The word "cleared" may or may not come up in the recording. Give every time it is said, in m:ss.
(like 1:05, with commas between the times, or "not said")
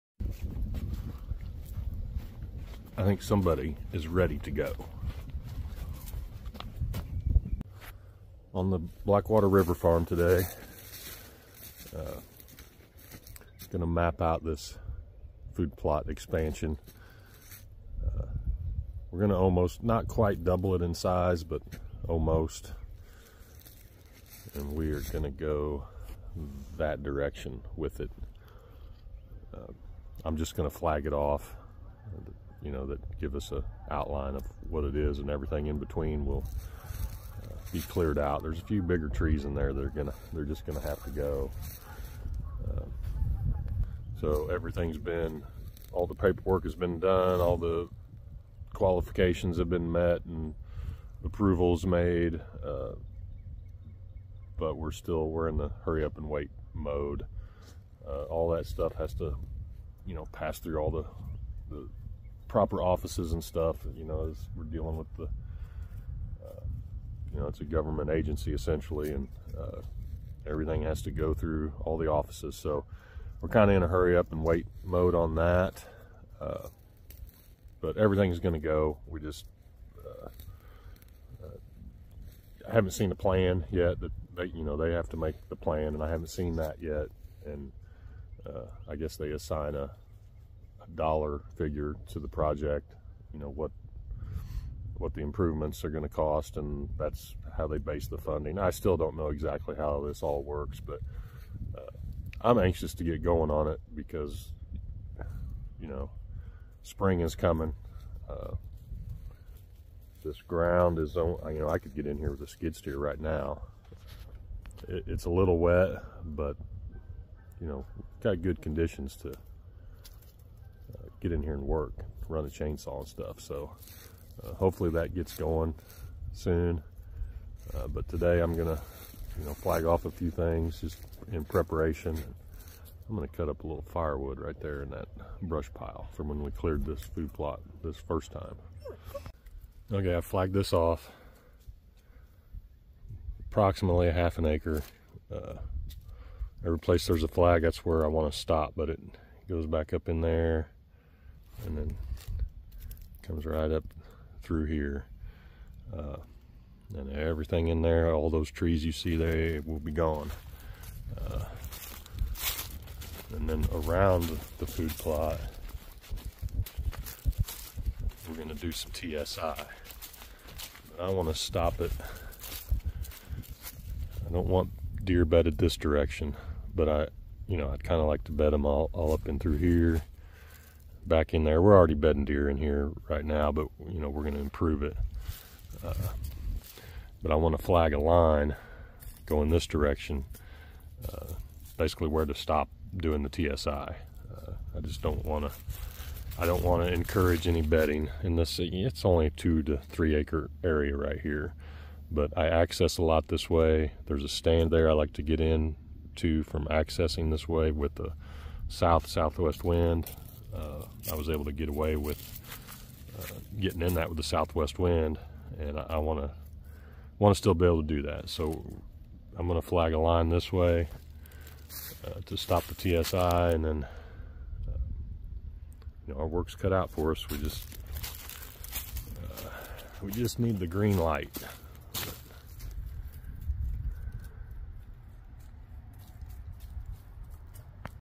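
0:37, 2:16.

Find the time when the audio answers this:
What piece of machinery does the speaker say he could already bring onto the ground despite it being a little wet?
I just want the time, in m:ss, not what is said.
1:52.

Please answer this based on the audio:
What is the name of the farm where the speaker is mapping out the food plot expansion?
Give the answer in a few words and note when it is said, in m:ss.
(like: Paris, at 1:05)
Blackwater River Farm, at 0:09.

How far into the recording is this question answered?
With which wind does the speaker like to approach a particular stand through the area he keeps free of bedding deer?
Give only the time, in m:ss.
3:28.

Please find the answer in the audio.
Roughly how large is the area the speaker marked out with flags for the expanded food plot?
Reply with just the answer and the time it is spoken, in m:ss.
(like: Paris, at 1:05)
half an acre, at 2:24.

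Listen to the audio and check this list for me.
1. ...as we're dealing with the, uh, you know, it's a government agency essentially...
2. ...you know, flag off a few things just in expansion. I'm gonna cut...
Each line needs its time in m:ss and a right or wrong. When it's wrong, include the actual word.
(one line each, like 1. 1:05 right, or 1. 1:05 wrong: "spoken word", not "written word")
1. 1:04 right
2. 2:09 wrong: "preparation", not "expansion".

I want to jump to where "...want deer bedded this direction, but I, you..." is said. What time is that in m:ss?
2:54.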